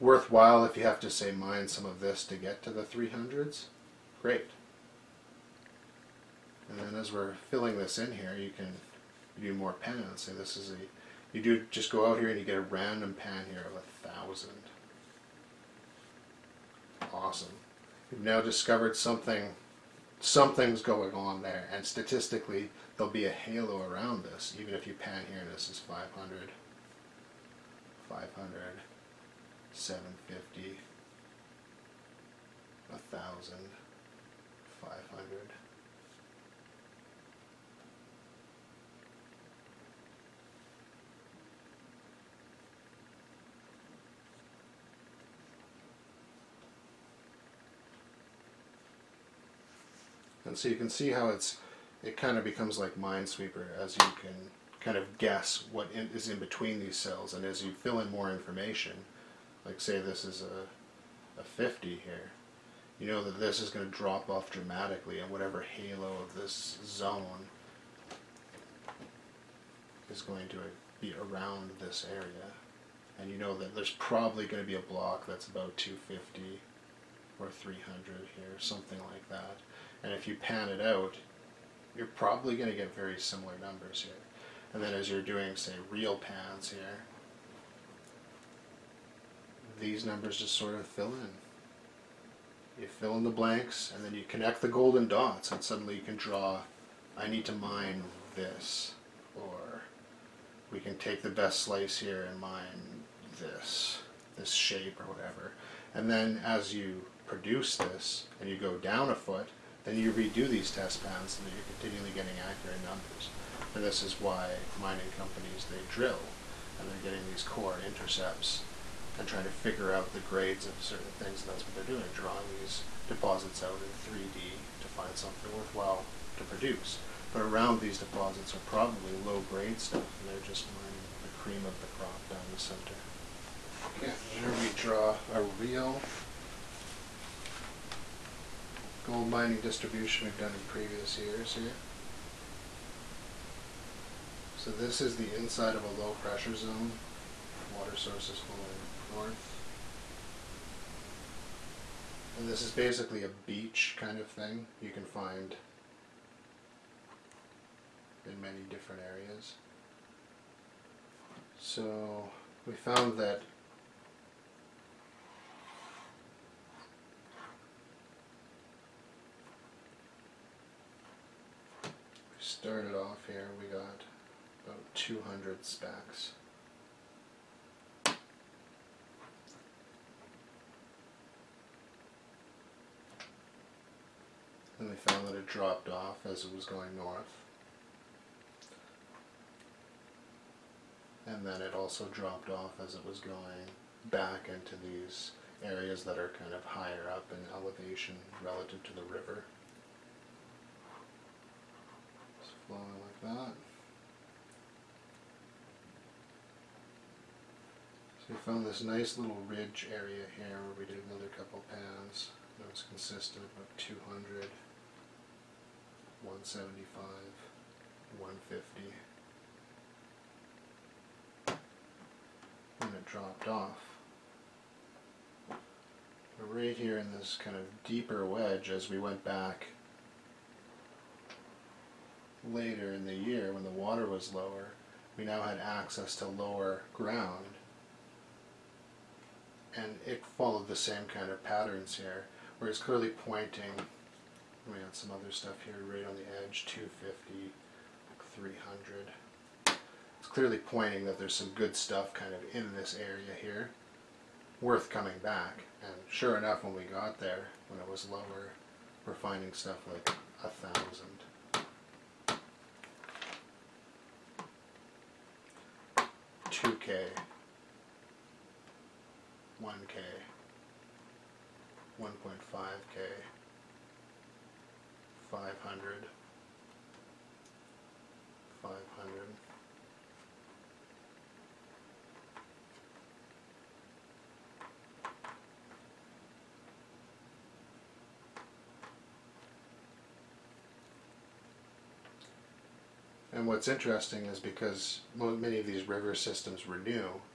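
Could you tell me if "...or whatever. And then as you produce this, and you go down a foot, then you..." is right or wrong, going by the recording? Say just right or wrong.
right.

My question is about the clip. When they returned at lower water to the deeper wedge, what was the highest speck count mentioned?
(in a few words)
2K.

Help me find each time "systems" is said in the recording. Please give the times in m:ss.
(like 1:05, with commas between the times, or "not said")
4:56.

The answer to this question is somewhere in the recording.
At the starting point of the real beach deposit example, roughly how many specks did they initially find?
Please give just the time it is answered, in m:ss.
2:54.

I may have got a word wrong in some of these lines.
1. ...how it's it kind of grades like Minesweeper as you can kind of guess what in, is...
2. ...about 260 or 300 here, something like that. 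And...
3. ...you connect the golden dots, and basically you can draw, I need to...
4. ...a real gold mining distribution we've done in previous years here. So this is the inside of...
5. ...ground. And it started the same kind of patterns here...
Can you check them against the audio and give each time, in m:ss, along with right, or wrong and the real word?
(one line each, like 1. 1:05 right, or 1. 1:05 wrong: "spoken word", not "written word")
1. 0:51 wrong: "becomes", not "grades"
2. 1:15 wrong: "250", not "260"
3. 1:34 wrong: "suddenly", not "basically"
4. 2:15 right
5. 3:56 wrong: "followed", not "started".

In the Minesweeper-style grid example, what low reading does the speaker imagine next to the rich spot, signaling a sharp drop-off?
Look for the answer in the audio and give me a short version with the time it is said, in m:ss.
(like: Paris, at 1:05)
50, at 1:01.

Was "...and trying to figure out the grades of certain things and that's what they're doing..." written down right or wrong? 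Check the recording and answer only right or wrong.
right.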